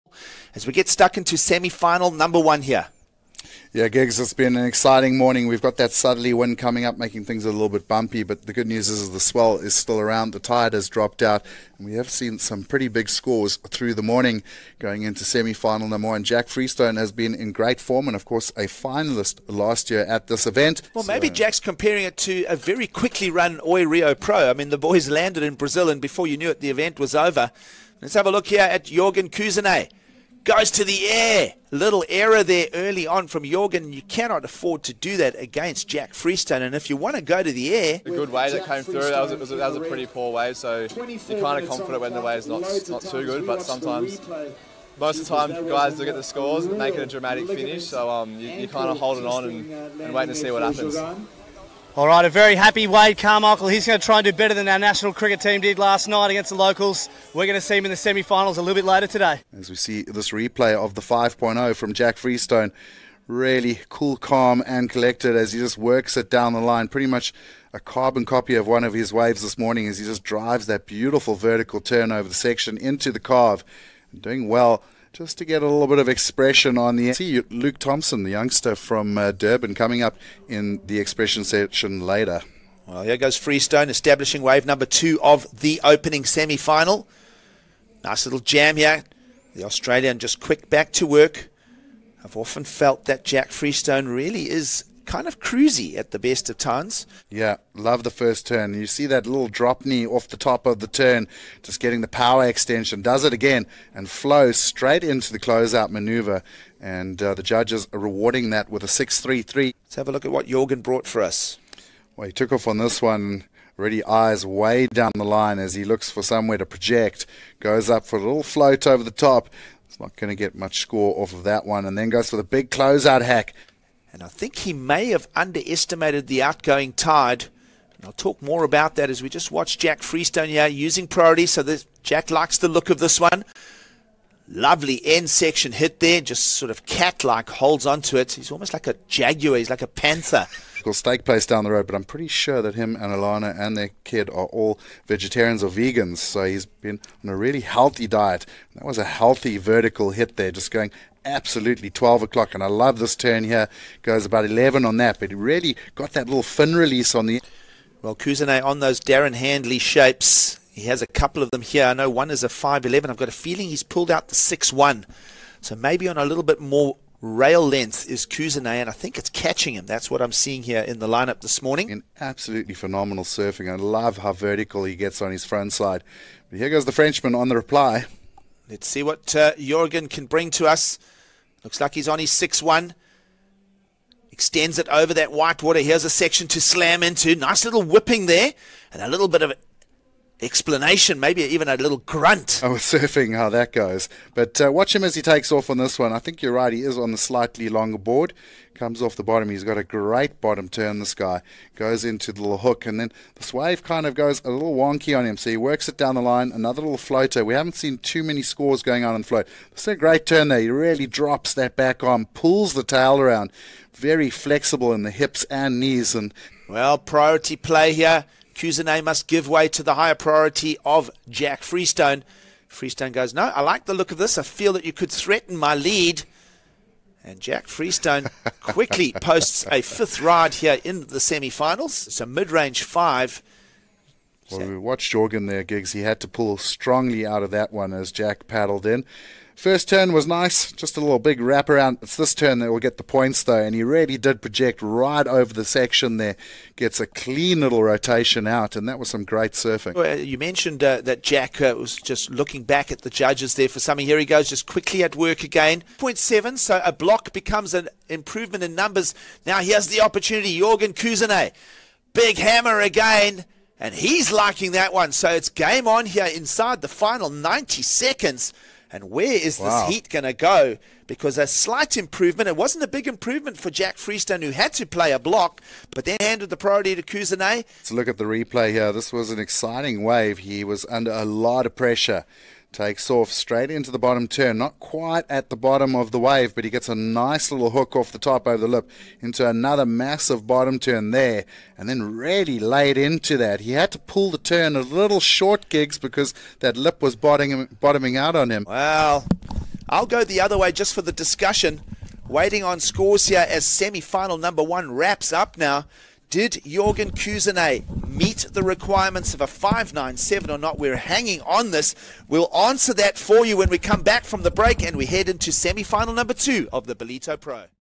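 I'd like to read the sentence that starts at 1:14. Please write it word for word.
Doing well just to get a little bit of expression on the.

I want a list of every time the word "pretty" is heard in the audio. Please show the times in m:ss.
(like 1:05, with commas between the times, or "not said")
0:12, 0:39, 1:06, 2:22.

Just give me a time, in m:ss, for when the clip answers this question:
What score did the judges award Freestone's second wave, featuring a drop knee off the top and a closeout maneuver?
1:48.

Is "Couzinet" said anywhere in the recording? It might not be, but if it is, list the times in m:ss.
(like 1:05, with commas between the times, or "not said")
0:29, 2:38, 2:48, 3:38, 4:20, 4:37, 5:07.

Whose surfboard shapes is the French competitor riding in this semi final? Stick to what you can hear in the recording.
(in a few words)
Darren Handley.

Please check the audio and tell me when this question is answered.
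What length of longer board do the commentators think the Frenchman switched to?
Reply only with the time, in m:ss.
2:44.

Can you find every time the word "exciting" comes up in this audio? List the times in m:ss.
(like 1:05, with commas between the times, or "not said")
0:04, 4:39.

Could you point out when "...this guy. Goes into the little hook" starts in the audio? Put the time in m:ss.
3:20.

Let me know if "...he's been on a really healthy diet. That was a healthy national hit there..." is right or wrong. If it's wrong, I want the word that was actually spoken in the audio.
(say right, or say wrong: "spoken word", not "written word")
wrong: "vertical", not "national".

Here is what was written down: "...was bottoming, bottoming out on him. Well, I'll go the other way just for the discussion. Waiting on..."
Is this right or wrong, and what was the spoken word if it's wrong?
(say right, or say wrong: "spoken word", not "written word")
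right.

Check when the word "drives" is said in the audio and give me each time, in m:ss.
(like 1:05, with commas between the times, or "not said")
1:10.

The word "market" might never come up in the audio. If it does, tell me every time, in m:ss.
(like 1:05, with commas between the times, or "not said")
not said.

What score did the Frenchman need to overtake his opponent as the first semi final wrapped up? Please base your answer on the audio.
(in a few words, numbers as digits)
5.97.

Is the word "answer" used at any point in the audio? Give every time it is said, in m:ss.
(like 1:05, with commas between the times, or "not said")
5:12.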